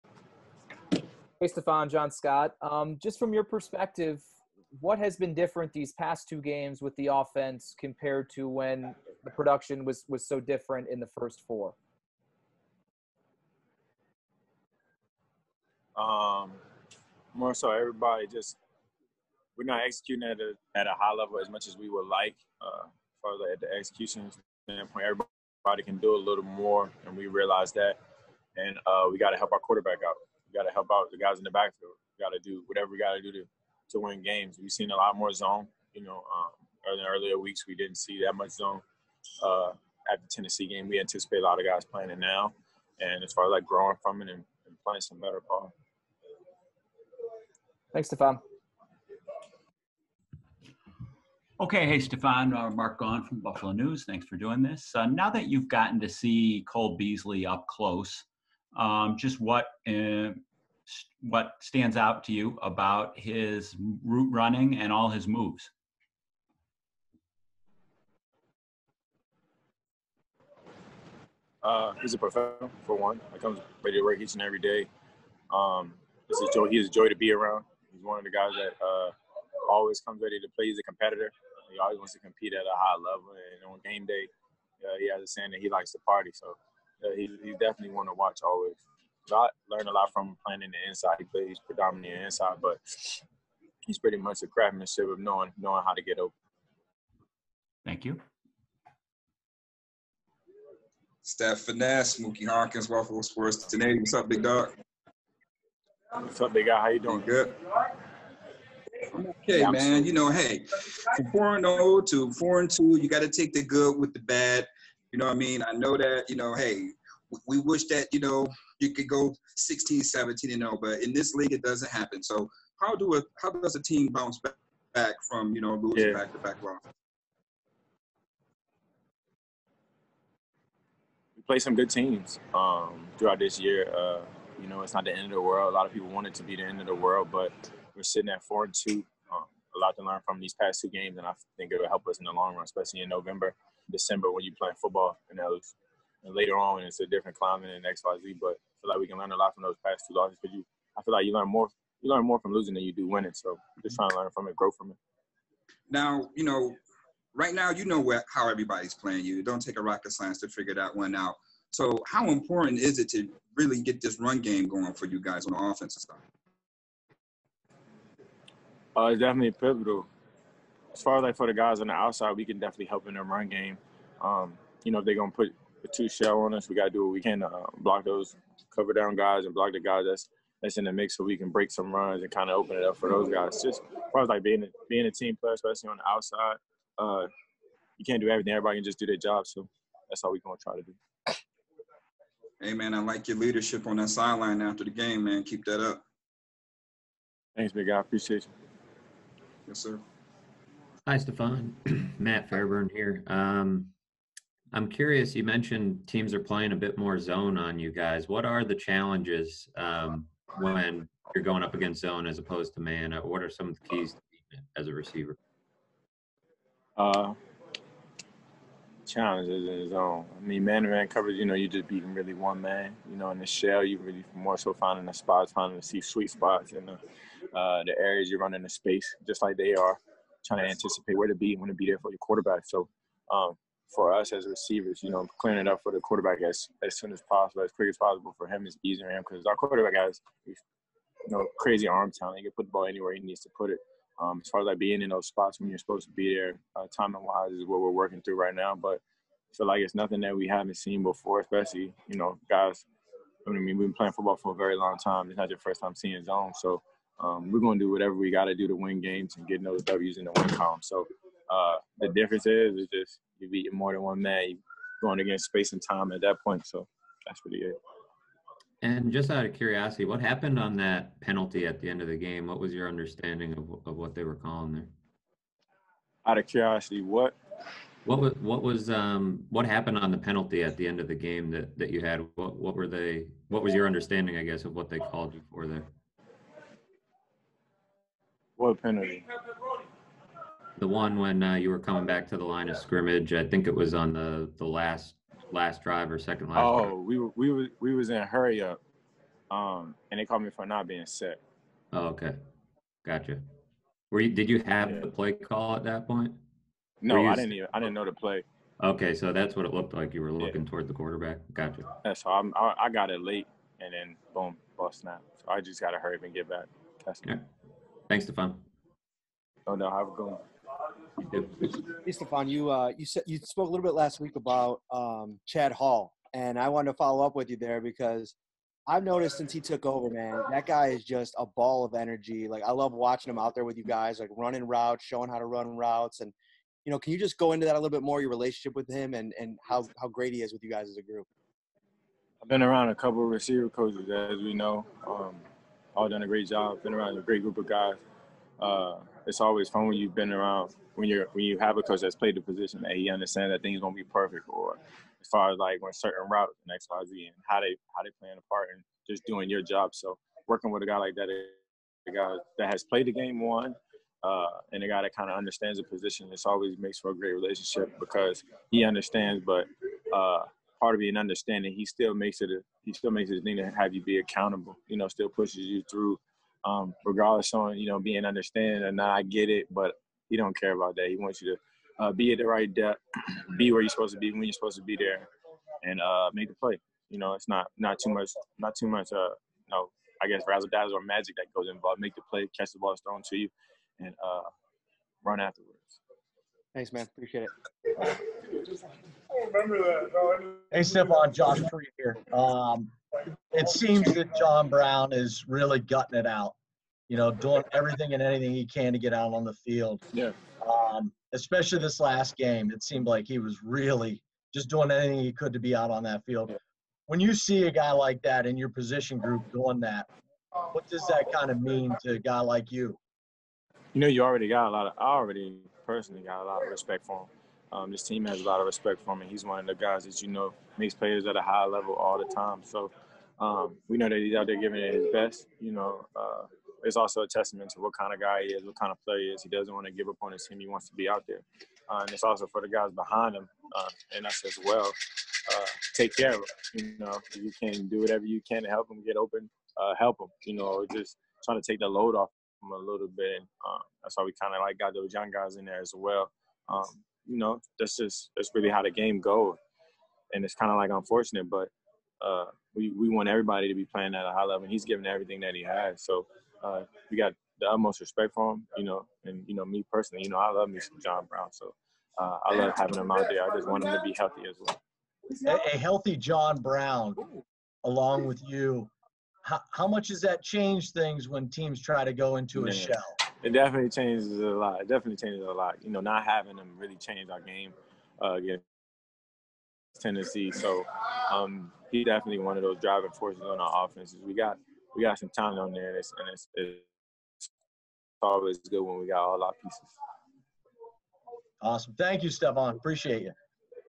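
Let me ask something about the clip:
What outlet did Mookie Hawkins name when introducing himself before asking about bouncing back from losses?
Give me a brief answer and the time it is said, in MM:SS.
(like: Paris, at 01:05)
Waffle Sports, at 01:42.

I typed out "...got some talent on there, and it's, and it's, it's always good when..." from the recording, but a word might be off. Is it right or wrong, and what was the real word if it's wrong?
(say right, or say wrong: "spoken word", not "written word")
right.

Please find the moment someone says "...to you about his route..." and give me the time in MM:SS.
01:02.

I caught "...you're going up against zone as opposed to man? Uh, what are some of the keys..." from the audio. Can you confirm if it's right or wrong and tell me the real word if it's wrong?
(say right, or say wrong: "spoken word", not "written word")
right.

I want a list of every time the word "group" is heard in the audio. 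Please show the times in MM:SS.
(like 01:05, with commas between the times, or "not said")
05:41, 05:47, 06:59.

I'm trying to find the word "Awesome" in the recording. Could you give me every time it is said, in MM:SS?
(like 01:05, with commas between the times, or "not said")
08:21.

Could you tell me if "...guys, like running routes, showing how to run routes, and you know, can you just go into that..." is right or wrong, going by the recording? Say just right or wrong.
right.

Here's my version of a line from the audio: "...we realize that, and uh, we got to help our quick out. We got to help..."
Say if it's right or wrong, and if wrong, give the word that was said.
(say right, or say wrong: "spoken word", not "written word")
wrong: "quarterback", not "quick".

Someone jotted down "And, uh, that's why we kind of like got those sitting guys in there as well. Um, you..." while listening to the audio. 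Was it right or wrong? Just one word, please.
wrong.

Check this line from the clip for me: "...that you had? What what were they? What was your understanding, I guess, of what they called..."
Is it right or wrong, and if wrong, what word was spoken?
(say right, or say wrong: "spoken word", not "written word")
right.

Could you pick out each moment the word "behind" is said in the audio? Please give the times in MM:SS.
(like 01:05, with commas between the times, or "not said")
07:22.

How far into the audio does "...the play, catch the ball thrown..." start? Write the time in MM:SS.
06:32.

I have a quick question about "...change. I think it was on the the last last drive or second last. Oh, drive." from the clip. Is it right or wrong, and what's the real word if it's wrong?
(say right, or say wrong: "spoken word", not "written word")
wrong: "scrimmage", not "change".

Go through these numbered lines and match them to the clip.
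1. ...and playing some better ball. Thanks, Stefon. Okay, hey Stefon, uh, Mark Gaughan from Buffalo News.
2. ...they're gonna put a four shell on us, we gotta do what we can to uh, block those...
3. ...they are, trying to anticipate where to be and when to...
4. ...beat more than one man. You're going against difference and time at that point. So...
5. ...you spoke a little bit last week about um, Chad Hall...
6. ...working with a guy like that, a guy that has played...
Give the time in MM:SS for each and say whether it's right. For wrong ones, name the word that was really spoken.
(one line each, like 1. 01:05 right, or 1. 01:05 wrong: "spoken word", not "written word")
1. 00:44 right
2. 02:55 wrong: "two", not "four"
3. 03:49 right
4. 04:23 wrong: "space", not "difference"
5. 05:23 right
6. 06:00 right.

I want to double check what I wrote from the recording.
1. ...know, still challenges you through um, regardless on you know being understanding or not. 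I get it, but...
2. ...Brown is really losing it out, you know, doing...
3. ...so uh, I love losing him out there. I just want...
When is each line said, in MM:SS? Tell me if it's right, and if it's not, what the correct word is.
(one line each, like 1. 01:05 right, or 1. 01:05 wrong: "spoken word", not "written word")
1. 06:14 wrong: "pushes", not "challenges"
2. 06:44 wrong: "gutting", not "losing"
3. 07:51 wrong: "having", not "losing".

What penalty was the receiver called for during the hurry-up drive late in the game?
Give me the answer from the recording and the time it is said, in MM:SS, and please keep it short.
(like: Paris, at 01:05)
not being set, at 05:00.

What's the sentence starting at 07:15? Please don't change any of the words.
You know, uh, it's also a testament to what kind of guy he is, what kind of player he is.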